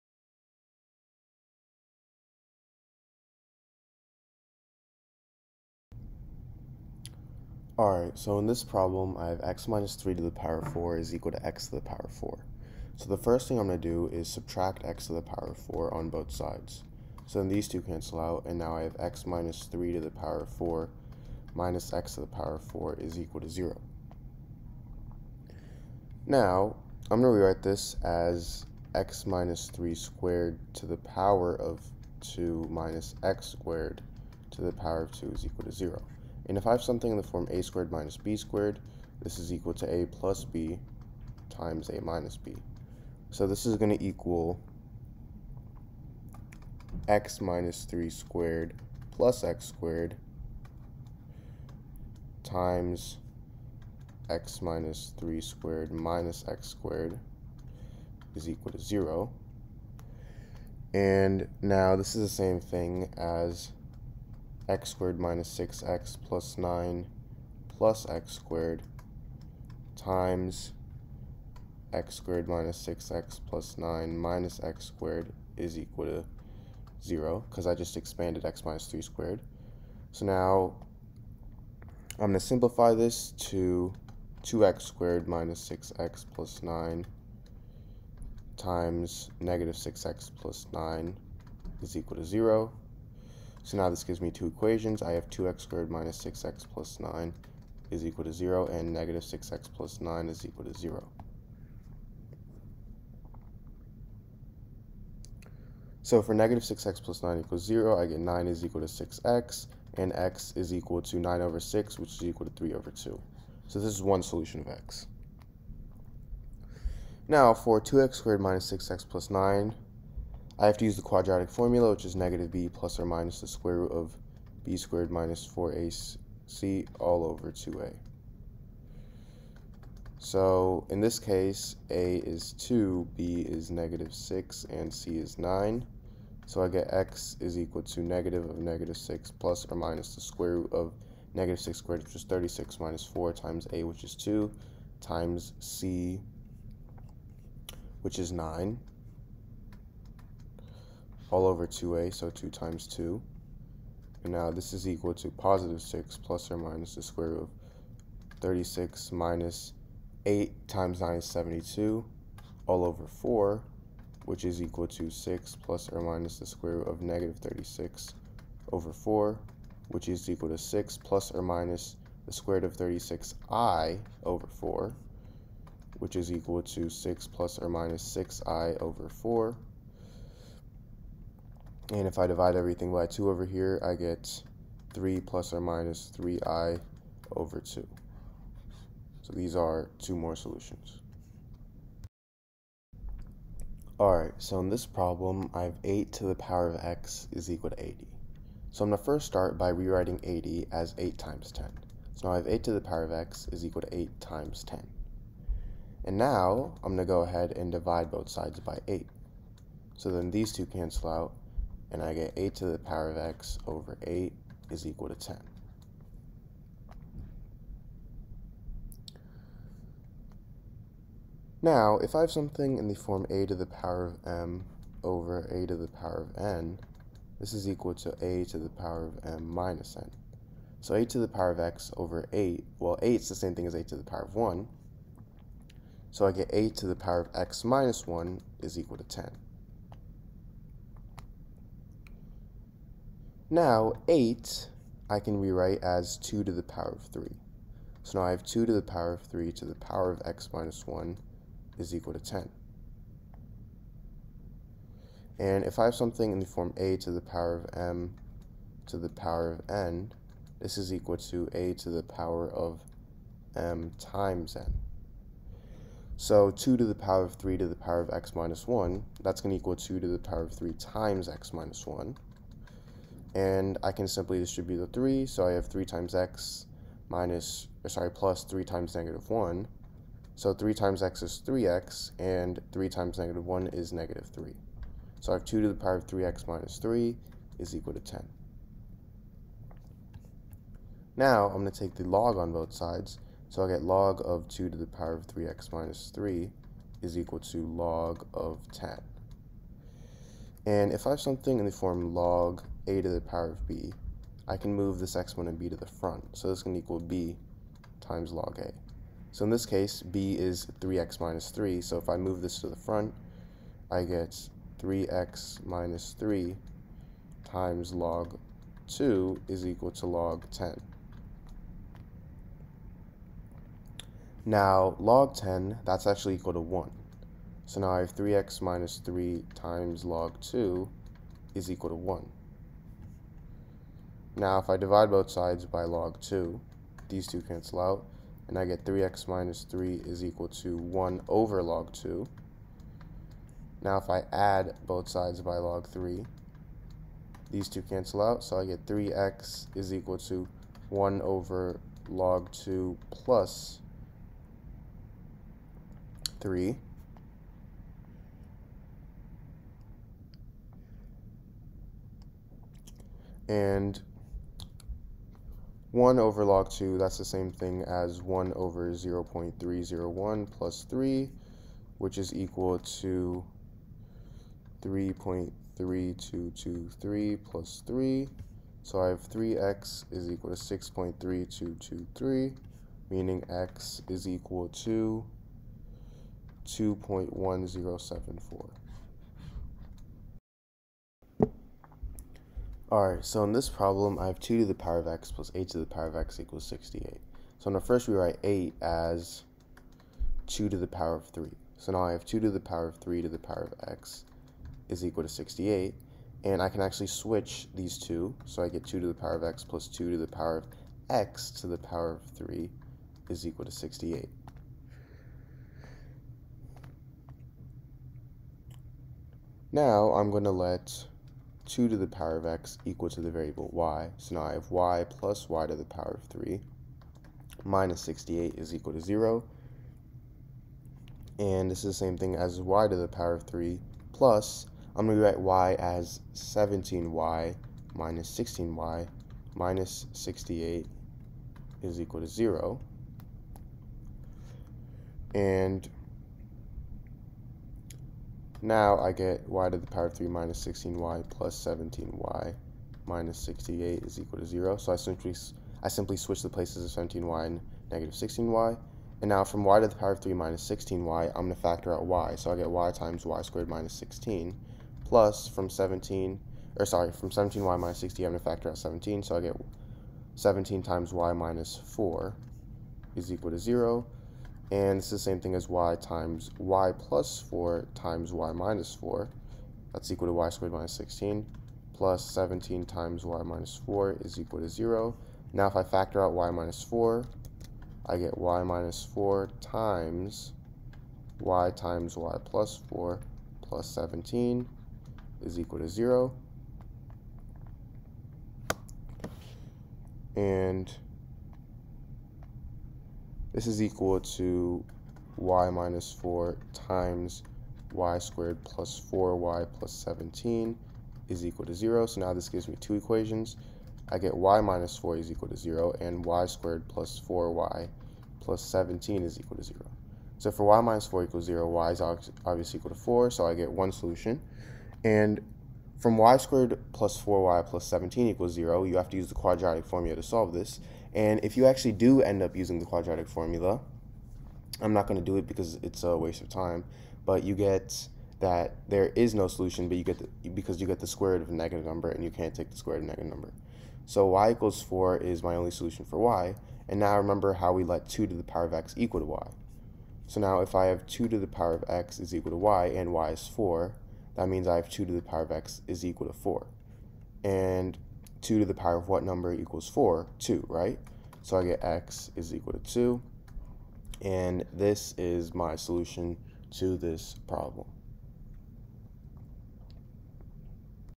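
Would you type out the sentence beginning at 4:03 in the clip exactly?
Now, 8 I can rewrite as 2 to the power of 3.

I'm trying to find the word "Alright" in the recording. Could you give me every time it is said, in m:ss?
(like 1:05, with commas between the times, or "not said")
0:07, 3:13, 6:32.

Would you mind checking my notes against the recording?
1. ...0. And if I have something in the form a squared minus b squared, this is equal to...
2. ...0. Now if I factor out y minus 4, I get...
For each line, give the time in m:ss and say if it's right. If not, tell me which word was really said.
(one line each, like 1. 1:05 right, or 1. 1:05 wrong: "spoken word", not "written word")
1. 0:35 right
2. 8:04 right.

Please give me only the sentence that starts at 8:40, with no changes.
So for y minus 4 equals 0, y is obviously equal to 4, so I get one solution.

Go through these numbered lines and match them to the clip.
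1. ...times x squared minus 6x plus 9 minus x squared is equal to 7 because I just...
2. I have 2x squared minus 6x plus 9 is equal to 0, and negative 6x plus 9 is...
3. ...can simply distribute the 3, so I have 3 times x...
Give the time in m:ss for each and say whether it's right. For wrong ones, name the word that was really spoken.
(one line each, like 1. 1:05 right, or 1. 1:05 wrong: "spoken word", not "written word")
1. 1:09 wrong: "0", not "7"
2. 1:35 right
3. 4:33 right.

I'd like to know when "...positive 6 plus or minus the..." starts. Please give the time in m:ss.
2:35.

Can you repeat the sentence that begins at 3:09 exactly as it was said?
So these are two more solutions.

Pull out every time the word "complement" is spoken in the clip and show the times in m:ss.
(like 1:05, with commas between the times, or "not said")
not said.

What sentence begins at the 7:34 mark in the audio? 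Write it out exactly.
So I simply, I simply switch the places of 17y and negative 16y.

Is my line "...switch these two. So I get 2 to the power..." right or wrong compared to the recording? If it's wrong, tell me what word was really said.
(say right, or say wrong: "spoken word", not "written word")
right.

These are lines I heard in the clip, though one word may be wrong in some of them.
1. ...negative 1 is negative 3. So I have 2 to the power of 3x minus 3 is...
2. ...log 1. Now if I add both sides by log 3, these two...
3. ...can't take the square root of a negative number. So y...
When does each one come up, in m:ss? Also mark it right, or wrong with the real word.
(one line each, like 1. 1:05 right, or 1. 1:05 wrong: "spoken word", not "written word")
1. 4:43 right
2. 5:41 wrong: "2", not "1"
3. 9:02 right.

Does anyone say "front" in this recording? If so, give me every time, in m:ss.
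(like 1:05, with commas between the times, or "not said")
5:05, 5:12.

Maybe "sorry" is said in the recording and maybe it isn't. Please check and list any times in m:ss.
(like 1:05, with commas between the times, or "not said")
4:37, 7:46.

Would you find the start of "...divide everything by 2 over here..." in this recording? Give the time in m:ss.
3:02.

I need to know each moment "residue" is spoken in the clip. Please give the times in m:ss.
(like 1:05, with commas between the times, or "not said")
not said.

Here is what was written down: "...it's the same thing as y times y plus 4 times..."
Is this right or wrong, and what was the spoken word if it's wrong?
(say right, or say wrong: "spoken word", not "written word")
right.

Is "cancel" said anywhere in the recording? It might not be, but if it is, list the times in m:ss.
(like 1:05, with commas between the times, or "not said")
0:17, 3:30, 5:37, 5:47.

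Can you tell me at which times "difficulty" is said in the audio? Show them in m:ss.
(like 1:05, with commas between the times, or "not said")
not said.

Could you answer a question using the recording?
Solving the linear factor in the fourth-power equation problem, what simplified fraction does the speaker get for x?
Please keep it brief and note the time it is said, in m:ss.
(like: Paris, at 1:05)
3/2, at 1:52.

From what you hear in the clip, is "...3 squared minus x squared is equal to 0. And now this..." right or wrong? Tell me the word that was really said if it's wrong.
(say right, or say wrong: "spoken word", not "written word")
right.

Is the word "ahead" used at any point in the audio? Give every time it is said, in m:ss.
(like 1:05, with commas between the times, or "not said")
3:27.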